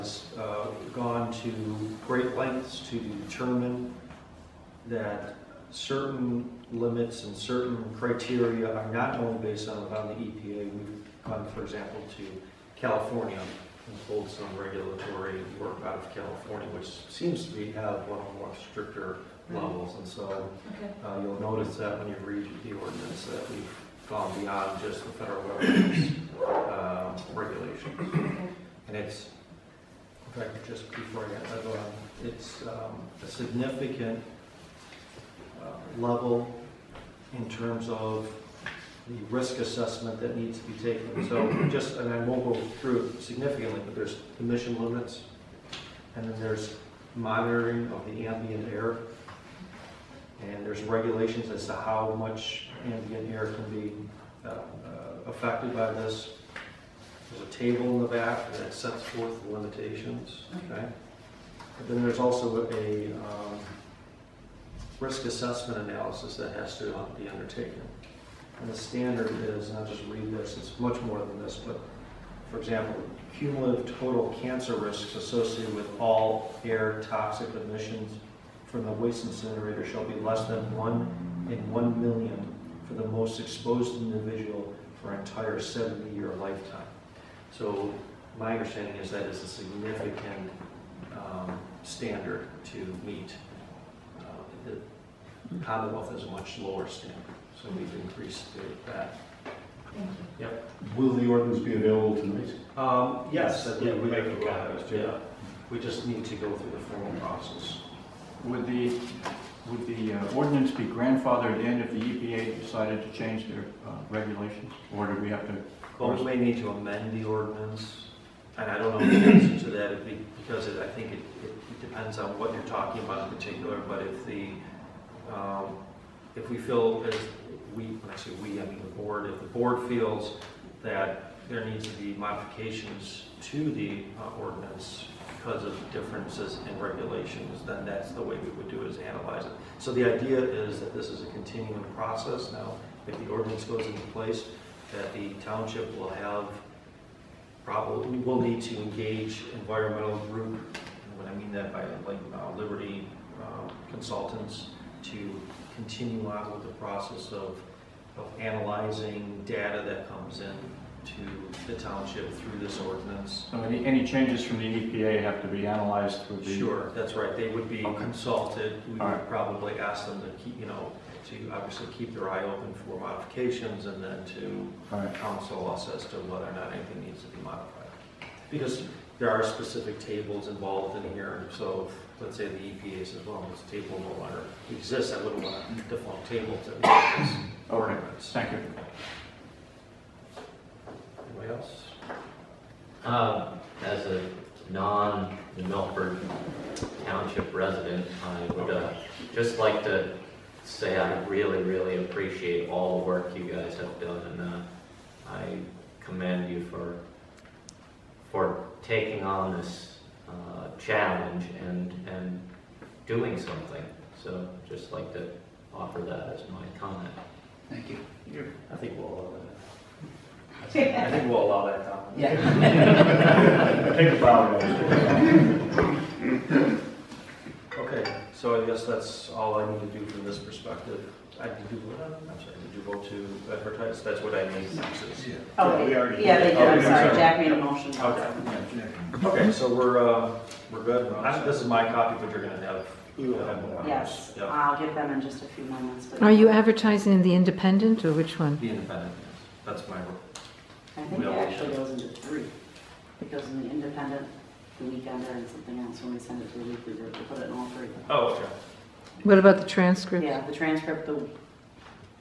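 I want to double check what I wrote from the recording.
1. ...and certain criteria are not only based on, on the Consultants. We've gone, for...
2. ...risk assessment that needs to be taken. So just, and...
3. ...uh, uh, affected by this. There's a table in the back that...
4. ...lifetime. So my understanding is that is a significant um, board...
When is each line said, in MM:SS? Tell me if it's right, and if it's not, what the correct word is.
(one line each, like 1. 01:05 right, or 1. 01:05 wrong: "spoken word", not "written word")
1. 00:07 wrong: "EPA", not "Consultants"
2. 00:39 right
3. 00:54 right
4. 01:26 wrong: "standard", not "board".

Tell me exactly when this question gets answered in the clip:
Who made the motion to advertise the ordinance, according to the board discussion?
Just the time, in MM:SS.
03:57.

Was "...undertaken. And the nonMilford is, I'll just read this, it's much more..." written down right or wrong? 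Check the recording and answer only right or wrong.
wrong.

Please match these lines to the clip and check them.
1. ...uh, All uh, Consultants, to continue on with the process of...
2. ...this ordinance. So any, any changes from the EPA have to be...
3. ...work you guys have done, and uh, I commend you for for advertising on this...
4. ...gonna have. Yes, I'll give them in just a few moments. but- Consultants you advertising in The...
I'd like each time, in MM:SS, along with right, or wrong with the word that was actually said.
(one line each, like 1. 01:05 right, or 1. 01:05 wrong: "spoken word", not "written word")
1. 02:32 wrong: "Liberty", not "All"
2. 02:42 right
3. 03:23 wrong: "taking", not "advertising"
4. 04:02 wrong: "Are", not "Consultants".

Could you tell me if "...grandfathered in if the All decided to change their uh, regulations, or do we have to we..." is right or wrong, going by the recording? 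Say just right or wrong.
wrong.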